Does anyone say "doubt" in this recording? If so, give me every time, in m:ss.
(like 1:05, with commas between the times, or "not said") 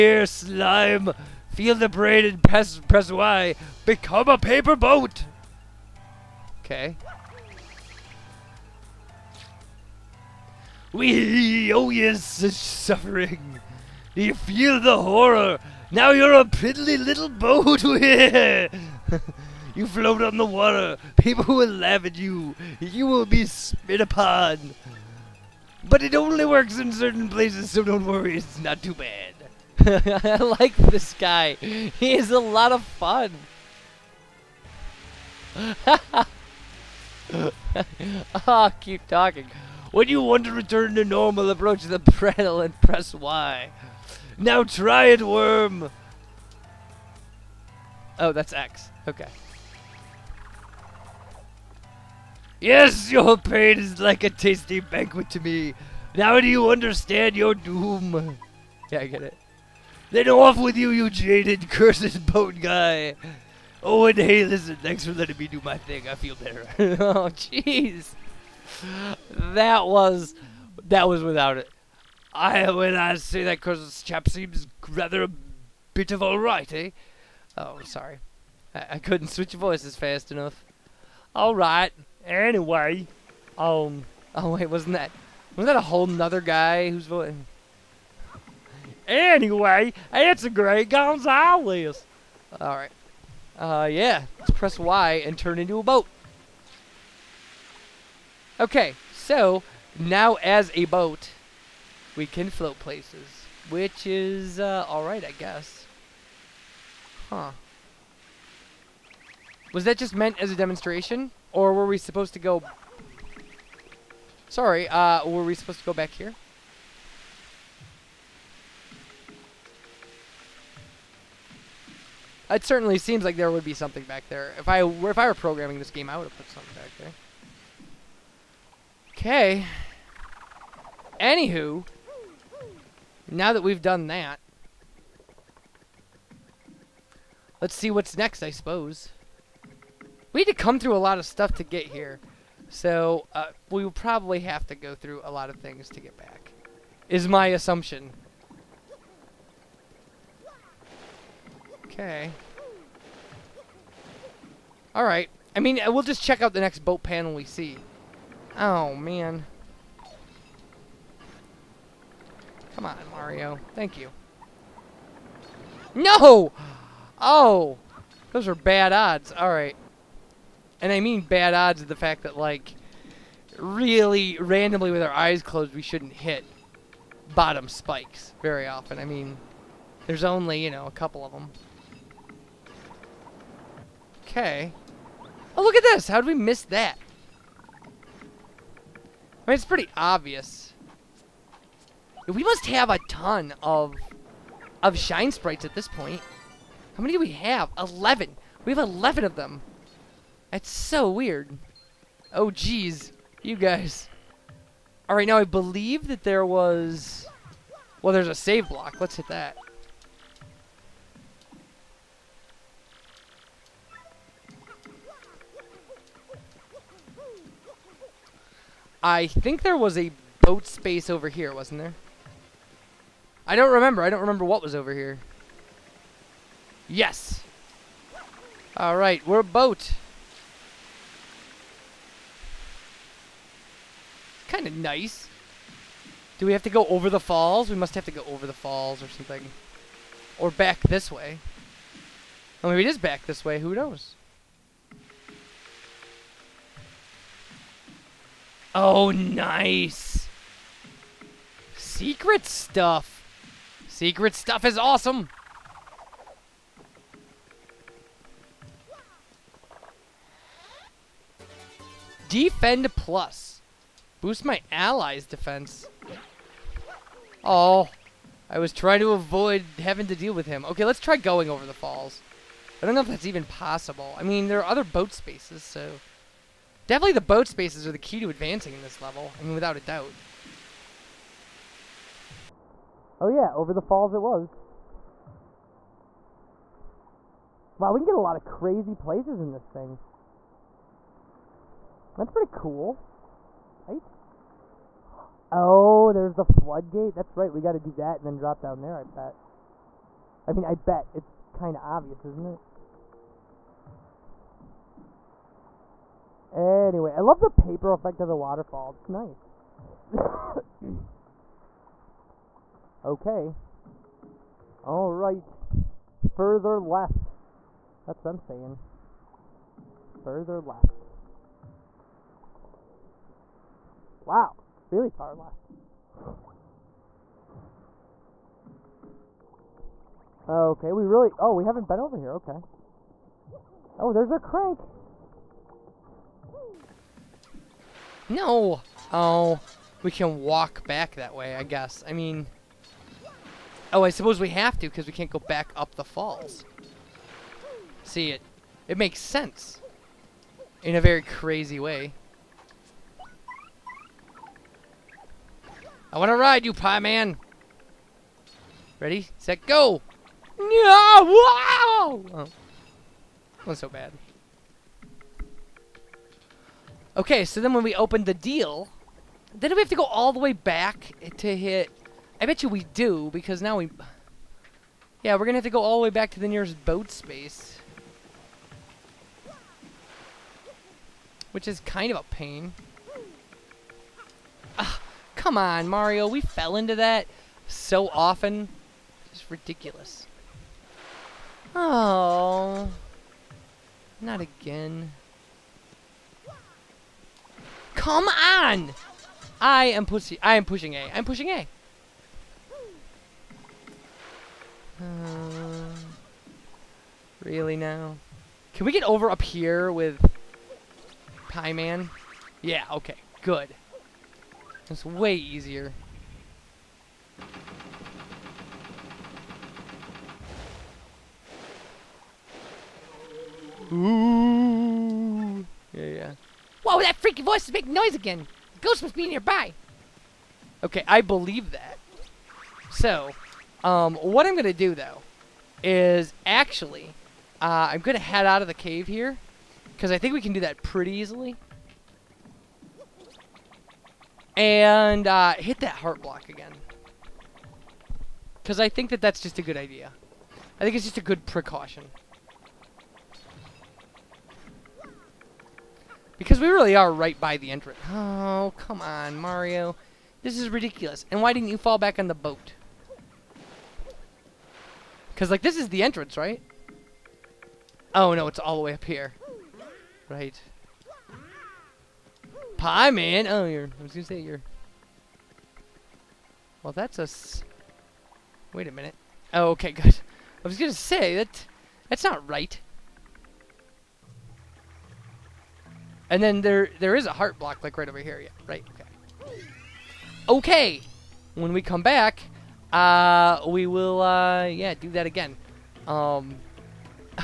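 4:39.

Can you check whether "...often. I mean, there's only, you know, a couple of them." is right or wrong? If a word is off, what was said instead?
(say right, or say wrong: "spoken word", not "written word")
right.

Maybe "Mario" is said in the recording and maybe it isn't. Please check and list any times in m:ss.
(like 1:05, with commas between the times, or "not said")
2:43, 6:25, 7:39.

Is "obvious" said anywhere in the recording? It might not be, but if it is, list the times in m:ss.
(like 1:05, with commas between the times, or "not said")
3:09, 5:01.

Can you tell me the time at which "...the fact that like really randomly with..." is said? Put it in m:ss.
2:51.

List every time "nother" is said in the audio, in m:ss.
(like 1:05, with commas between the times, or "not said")
1:26.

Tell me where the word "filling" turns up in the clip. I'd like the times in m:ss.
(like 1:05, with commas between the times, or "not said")
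not said.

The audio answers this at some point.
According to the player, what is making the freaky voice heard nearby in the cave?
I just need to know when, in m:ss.
7:08.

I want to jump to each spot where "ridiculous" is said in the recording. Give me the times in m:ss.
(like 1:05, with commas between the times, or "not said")
6:29, 7:40.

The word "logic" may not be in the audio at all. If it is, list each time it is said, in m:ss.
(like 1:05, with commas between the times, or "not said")
not said.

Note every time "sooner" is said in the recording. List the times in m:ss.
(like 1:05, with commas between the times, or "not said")
not said.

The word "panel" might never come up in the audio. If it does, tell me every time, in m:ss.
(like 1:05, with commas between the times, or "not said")
0:41, 2:37.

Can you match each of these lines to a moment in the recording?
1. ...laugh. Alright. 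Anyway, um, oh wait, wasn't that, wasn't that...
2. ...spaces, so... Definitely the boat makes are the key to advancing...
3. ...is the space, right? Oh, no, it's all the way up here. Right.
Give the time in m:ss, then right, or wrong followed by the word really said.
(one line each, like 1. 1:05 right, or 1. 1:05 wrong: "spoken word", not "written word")
1. 1:20 wrong: "enough", not "laugh"
2. 4:35 wrong: "spaces", not "makes"
3. 7:45 wrong: "entrance", not "space".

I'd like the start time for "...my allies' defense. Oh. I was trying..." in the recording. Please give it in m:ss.
4:24.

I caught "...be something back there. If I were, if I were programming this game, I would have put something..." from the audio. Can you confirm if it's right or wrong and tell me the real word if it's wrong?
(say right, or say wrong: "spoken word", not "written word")
right.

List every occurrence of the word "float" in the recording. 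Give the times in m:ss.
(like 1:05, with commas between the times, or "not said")
0:19, 1:42.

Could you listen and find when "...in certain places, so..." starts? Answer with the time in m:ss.
0:26.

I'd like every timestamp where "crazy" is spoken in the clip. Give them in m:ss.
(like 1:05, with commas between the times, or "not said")
4:48, 5:51.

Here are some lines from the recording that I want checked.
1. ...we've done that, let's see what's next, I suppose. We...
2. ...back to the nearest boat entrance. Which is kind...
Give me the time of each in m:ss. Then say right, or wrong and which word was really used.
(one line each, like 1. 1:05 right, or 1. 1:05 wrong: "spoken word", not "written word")
1. 2:13 right
2. 6:16 wrong: "space", not "entrance".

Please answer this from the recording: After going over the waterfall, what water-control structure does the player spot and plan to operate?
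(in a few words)
The floodgate.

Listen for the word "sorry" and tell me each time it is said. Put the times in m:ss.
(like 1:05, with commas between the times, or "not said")
1:17, 1:54.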